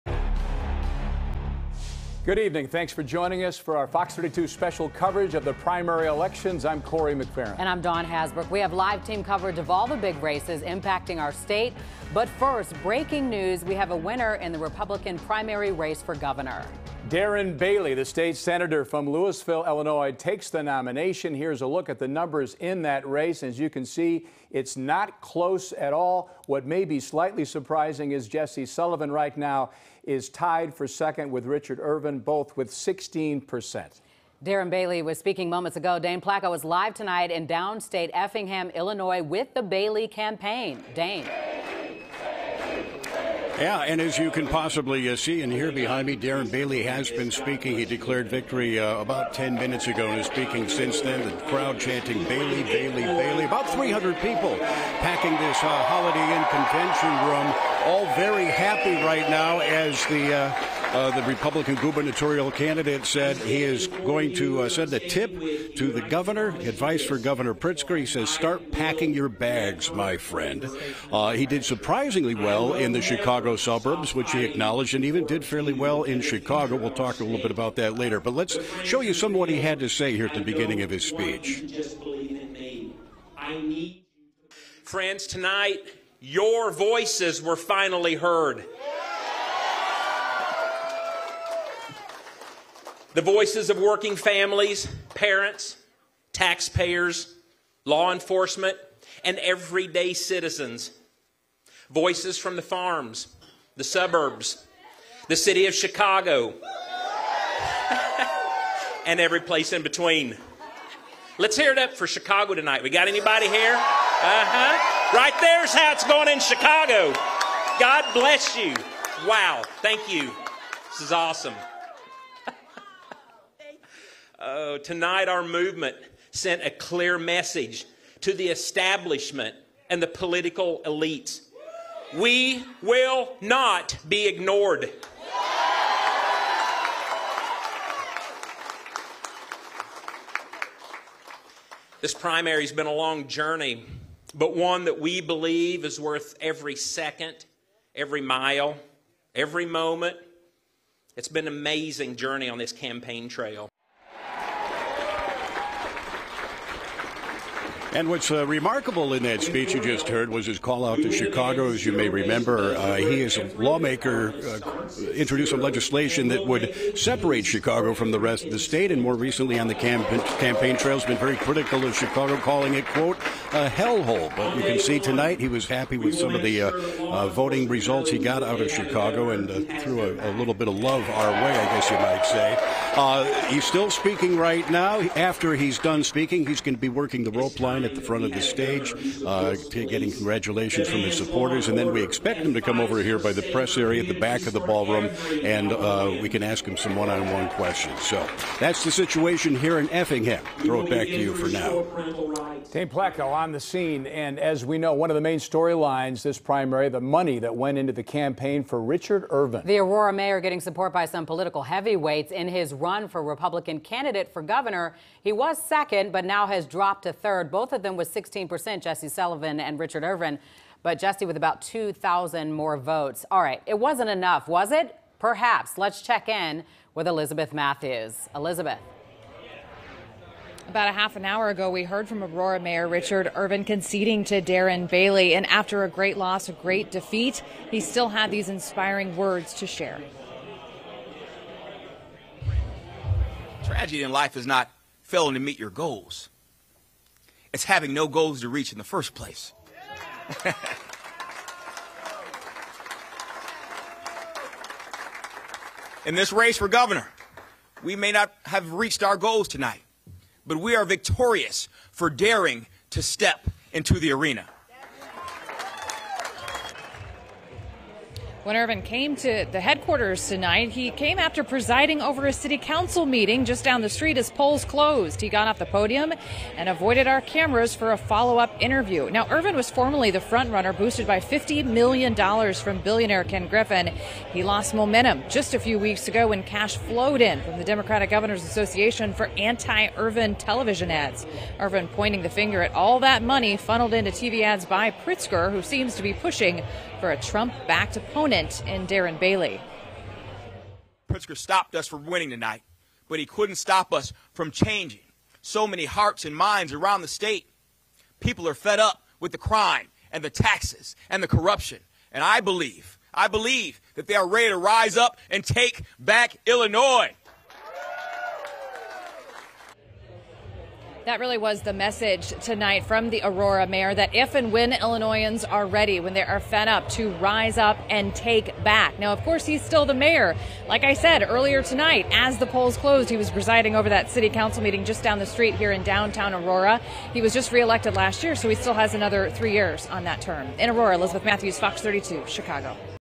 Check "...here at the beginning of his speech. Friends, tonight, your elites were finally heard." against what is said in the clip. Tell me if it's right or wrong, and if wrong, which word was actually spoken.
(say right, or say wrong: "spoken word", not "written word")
wrong: "voices", not "elites".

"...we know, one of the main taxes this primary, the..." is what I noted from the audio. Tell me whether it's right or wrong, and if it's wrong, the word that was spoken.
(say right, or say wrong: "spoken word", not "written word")
wrong: "storylines", not "taxes".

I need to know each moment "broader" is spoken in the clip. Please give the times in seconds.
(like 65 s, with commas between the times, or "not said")
not said.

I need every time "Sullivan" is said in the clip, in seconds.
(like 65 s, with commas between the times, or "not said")
28 s, 219 s.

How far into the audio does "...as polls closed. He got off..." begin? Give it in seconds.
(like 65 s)
274 s.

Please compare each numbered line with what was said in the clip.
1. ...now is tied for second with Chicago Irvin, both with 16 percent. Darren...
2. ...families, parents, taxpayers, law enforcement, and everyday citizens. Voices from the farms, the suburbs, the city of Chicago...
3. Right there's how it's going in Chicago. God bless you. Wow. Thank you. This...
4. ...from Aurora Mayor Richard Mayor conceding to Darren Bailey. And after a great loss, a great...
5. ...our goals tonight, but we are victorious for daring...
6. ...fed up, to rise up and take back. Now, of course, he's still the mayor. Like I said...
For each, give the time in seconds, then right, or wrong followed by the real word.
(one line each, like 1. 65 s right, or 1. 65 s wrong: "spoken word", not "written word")
1. 29 s wrong: "Richard", not "Chicago"
2. 94 s right
3. 115 s right
4. 232 s wrong: "Irvin", not "Mayor"
5. 259 s right
6. 326 s right.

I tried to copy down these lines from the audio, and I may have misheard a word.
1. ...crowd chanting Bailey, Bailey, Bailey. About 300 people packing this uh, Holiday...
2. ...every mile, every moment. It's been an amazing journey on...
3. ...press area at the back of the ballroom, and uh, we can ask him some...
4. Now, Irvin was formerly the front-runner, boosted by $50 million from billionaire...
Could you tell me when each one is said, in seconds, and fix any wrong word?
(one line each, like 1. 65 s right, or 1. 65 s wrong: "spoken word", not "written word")
1. 51 s right
2. 147 s right
3. 193 s right
4. 279 s right.